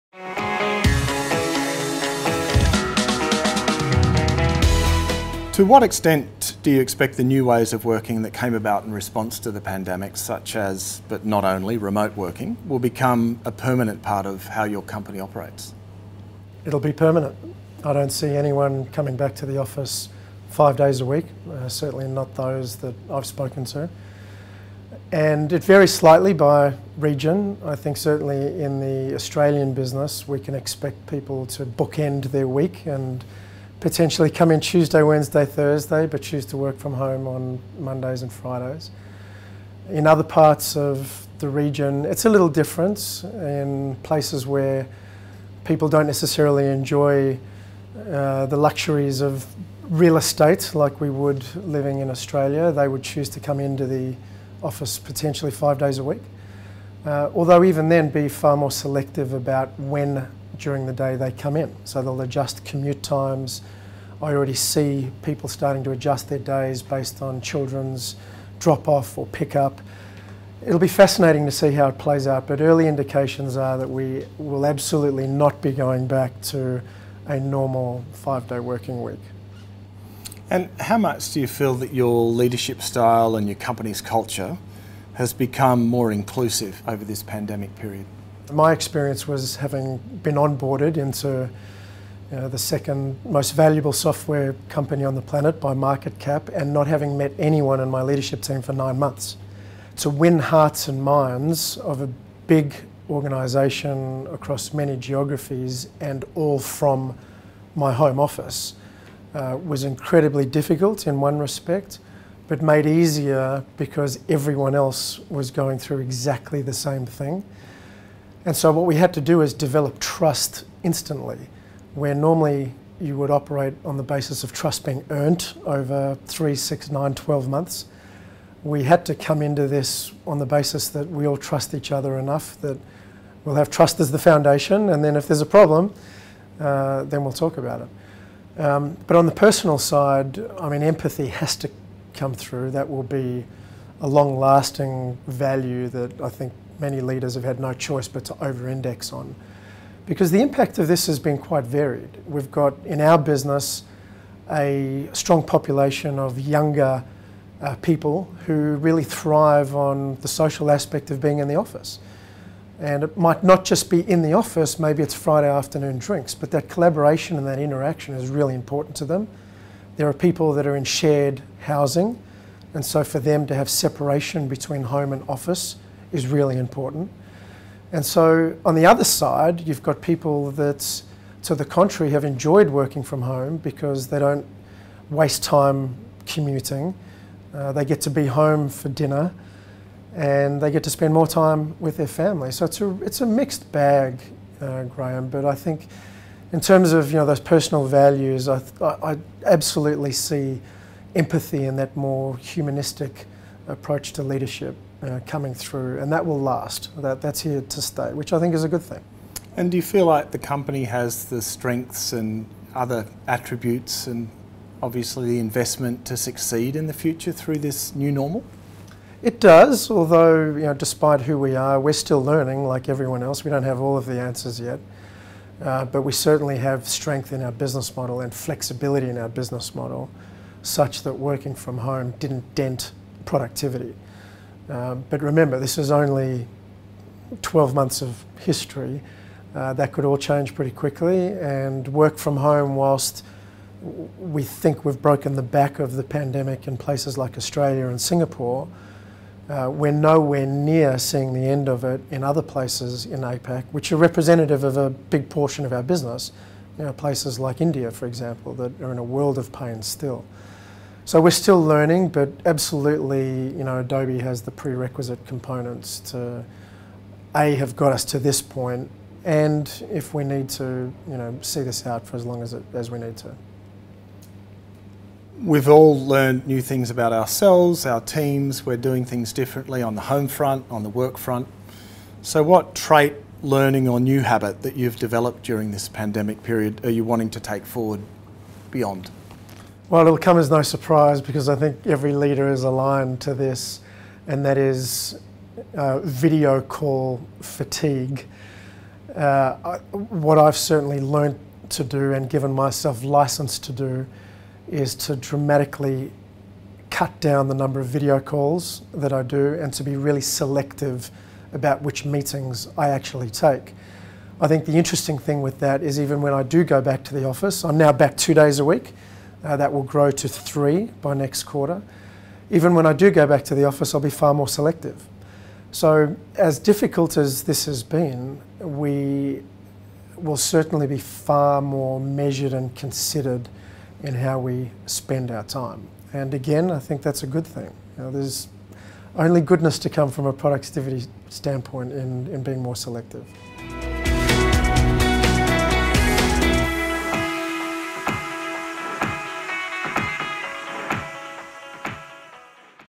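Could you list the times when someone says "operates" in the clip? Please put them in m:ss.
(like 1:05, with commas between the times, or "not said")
0:15, 2:03.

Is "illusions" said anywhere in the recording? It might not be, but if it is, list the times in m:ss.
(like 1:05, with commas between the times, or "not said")
not said.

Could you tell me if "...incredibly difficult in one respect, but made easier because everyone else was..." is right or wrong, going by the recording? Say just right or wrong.
right.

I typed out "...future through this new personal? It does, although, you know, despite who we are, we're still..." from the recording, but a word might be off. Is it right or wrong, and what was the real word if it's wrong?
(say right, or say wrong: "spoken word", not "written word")
wrong: "normal", not "personal".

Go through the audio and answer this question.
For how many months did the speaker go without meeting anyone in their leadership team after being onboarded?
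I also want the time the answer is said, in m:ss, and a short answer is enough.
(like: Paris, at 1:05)
9, at 1:38.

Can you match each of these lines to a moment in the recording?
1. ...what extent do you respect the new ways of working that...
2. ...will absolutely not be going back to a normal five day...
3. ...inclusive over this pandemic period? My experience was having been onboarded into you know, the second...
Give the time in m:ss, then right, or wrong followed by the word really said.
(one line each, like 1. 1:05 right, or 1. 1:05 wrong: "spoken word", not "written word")
1. 0:05 wrong: "expect", not "respect"
2. 1:14 right
3. 1:26 right.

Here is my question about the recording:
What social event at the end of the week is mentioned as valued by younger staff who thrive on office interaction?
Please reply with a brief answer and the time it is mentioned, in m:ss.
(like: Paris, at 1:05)
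Friday afternoon drinks, at 2:45.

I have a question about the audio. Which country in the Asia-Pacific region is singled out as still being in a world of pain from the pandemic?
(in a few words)
India.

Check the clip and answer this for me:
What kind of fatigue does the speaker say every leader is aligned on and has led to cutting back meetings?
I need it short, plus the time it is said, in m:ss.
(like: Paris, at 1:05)
Video call fatigue, at 4:55.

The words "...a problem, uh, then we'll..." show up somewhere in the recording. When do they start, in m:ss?
2:15.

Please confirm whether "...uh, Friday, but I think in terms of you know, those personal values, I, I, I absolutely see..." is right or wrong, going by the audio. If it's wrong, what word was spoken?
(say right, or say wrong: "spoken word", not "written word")
wrong: "Graham", not "Friday".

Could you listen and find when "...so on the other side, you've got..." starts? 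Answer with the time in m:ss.
2:58.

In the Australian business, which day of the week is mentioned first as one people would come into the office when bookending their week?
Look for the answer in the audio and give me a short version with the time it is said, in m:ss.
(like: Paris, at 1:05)
Tuesday, at 0:34.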